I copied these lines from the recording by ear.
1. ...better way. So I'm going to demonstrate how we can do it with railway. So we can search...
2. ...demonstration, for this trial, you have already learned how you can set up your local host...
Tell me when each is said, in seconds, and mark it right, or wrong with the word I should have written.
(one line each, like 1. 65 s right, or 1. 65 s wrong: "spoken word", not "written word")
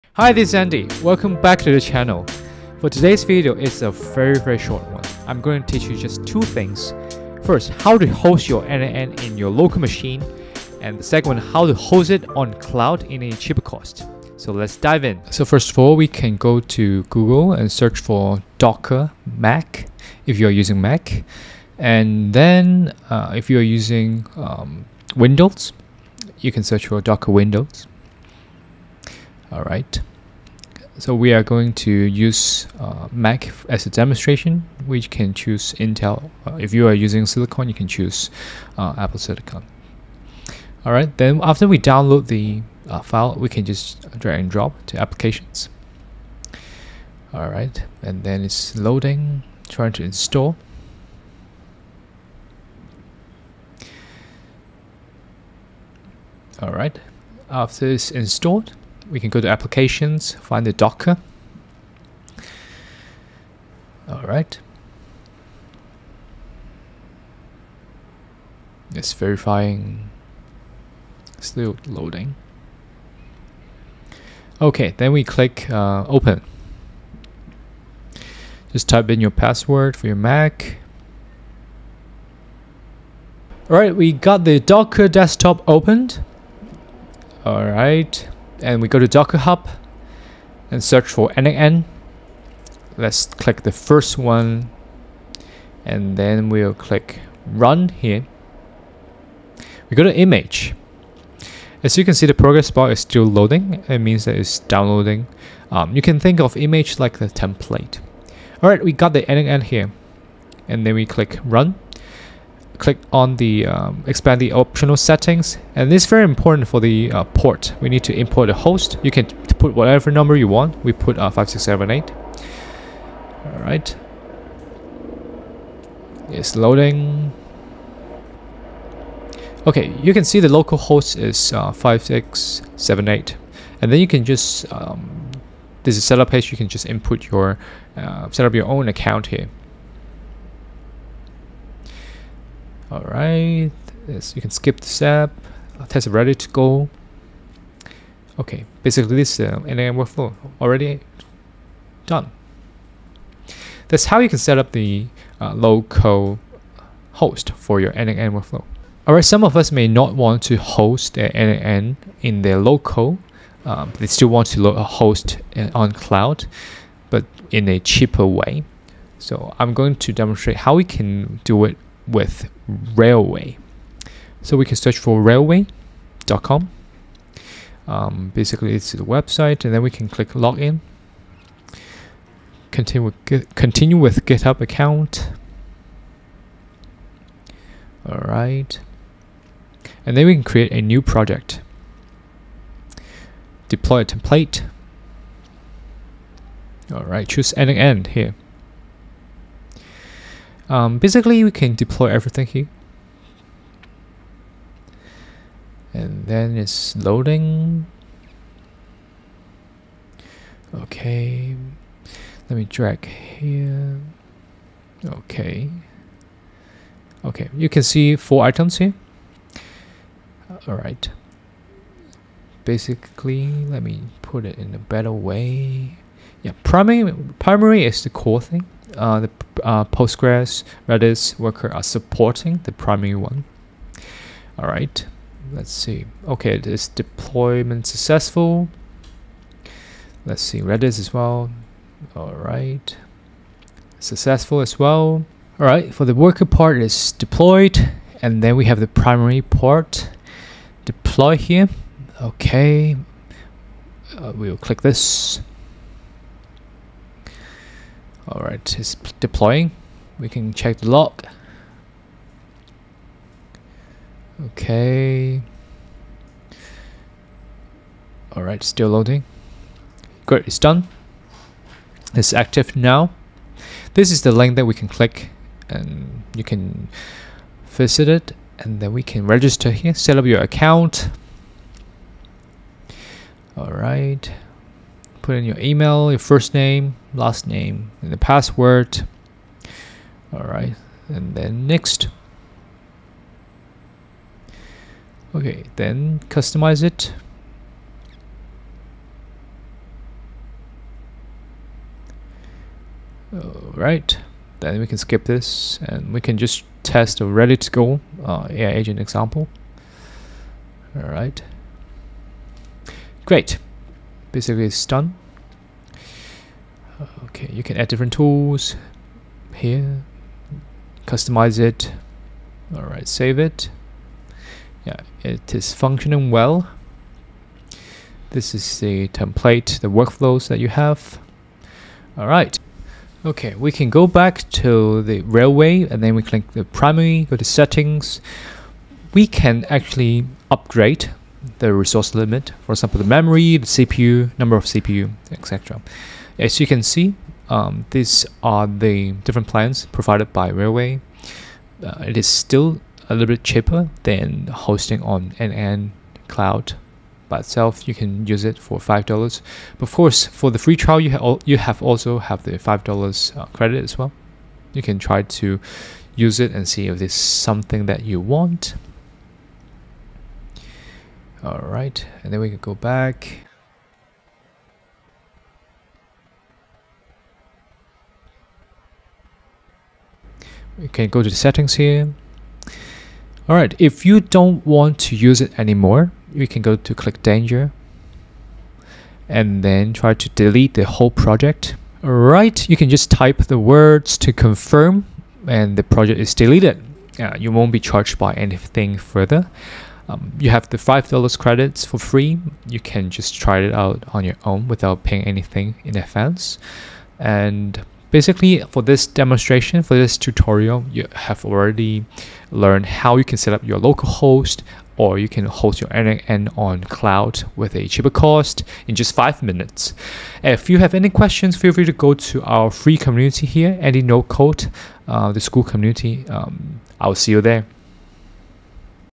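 1. 167 s wrong: "cheaper", not "better"
2. 409 s wrong: "tutorial", not "trial".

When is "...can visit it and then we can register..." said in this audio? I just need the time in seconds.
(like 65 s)
276 s.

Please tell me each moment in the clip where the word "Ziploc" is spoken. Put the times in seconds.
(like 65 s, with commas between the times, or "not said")
not said.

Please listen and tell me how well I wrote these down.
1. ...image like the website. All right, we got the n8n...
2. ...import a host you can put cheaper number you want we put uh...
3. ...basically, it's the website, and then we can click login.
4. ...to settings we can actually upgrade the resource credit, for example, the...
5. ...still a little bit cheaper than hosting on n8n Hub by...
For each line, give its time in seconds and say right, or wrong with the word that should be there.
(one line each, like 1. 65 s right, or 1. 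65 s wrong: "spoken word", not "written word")
1. 106 s wrong: "template", not "website"
2. 118 s wrong: "whatever", not "cheaper"
3. 178 s right
4. 337 s wrong: "limit", not "credit"
5. 352 s wrong: "Cloud", not "Hub".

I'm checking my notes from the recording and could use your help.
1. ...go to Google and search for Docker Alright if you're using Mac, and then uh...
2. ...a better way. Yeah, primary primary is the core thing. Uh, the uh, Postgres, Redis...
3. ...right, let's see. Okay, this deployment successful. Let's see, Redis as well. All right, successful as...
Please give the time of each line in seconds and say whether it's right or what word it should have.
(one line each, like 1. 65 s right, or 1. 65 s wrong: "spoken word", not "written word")
1. 16 s wrong: "Mac", not "Alright"
2. 224 s right
3. 234 s right.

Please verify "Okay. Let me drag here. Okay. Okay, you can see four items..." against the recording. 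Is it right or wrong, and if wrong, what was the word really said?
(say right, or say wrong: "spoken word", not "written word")
right.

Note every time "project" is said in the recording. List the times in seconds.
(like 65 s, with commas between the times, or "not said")
191 s, 391 s, 395 s.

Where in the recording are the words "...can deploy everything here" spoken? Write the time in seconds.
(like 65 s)
201 s.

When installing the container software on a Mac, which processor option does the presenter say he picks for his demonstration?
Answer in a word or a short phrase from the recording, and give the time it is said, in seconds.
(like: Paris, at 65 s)
Intel, at 35 s.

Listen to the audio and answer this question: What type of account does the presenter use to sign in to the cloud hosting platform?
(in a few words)
GitHub.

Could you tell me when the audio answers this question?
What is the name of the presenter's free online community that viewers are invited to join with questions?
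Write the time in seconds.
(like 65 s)
423 s.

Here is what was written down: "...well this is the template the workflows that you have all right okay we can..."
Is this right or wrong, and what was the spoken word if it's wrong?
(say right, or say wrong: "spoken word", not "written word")
right.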